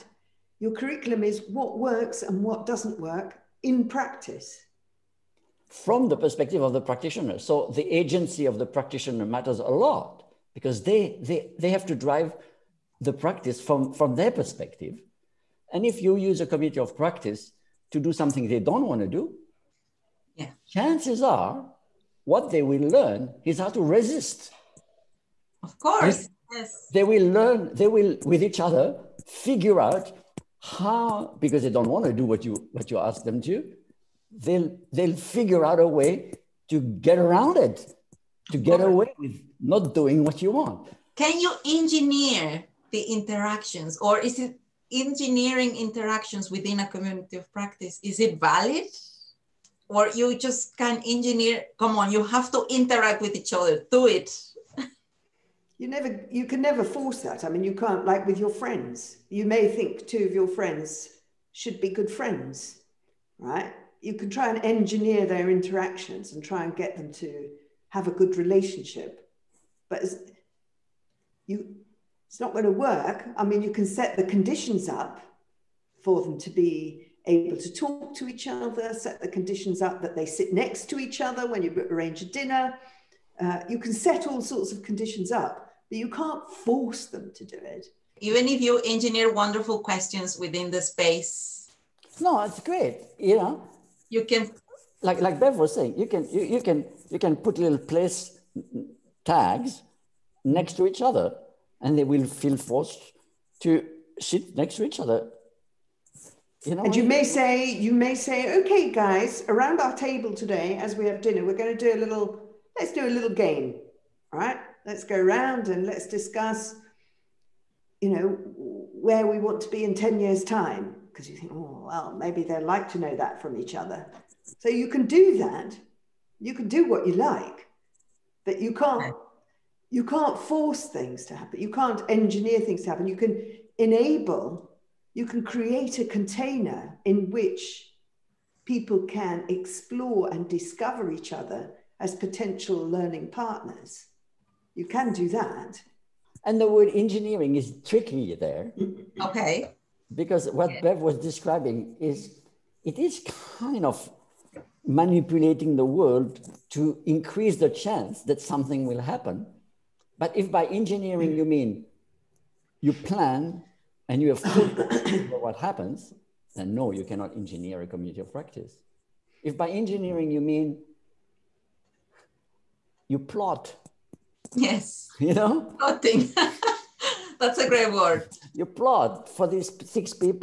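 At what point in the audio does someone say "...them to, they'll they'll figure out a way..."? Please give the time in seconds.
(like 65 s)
33 s.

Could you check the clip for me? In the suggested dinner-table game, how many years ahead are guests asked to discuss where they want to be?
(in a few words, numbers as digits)
10.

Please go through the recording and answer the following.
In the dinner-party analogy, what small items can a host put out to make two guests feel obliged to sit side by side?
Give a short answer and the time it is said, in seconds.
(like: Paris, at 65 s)
Place tags, at 97 s.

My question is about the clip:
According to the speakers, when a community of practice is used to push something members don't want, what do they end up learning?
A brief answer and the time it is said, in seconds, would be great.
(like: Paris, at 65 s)
How to resist, at 23 s.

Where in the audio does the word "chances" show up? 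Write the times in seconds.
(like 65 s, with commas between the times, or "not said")
20 s, 157 s.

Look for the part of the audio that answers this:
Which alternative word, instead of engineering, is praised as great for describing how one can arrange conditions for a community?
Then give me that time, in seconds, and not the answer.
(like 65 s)
175 s.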